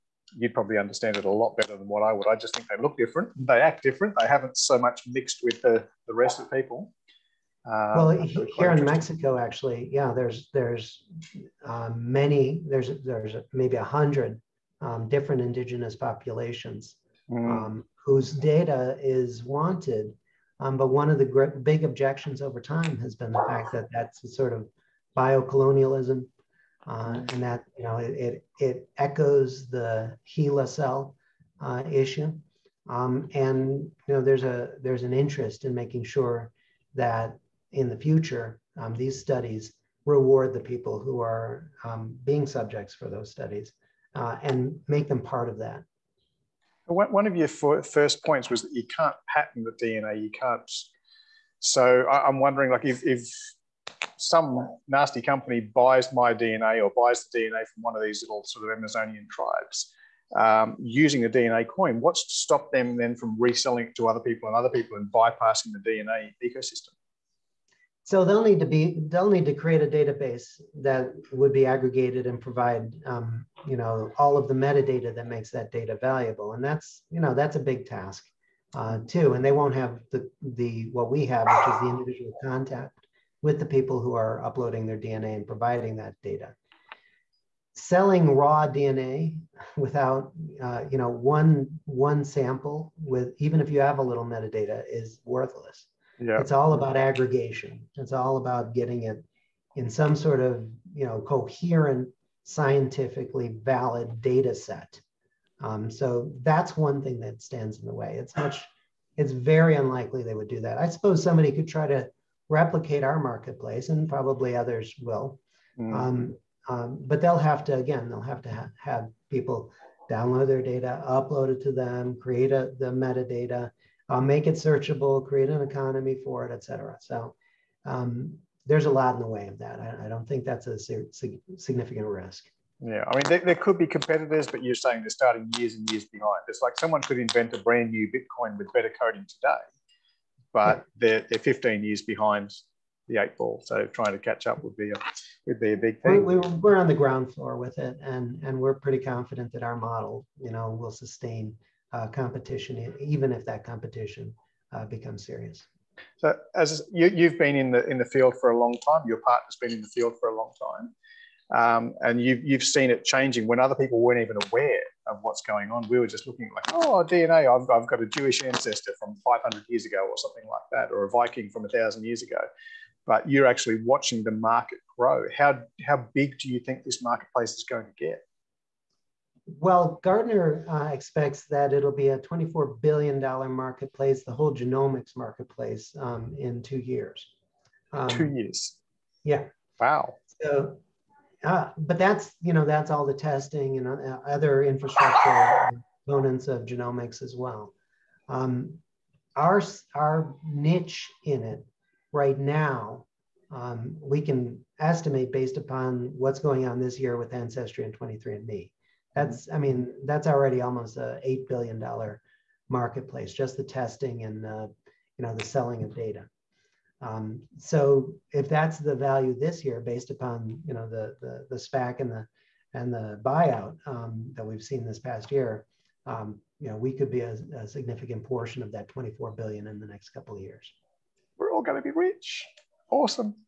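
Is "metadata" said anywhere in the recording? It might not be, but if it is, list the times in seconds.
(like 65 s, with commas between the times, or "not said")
74 s, 94 s, 122 s.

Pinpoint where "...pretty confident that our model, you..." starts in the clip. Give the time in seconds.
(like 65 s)
148 s.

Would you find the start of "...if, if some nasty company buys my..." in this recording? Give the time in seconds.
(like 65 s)
52 s.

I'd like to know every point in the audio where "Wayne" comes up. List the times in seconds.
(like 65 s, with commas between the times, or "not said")
not said.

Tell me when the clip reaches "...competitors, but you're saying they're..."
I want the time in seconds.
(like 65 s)
133 s.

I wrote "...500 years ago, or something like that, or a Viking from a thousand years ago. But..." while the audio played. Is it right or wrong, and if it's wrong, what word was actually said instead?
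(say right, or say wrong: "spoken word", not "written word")
right.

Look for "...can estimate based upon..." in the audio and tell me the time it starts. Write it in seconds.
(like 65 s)
204 s.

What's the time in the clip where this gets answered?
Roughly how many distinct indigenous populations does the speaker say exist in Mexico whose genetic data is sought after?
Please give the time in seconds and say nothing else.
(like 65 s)
13 s.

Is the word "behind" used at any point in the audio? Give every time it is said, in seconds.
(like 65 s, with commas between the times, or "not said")
136 s, 142 s.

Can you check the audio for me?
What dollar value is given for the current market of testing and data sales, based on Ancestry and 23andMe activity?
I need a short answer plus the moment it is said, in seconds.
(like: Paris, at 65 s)
$8 billion, at 211 s.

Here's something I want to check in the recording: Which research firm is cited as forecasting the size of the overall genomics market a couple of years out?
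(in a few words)
Gartner.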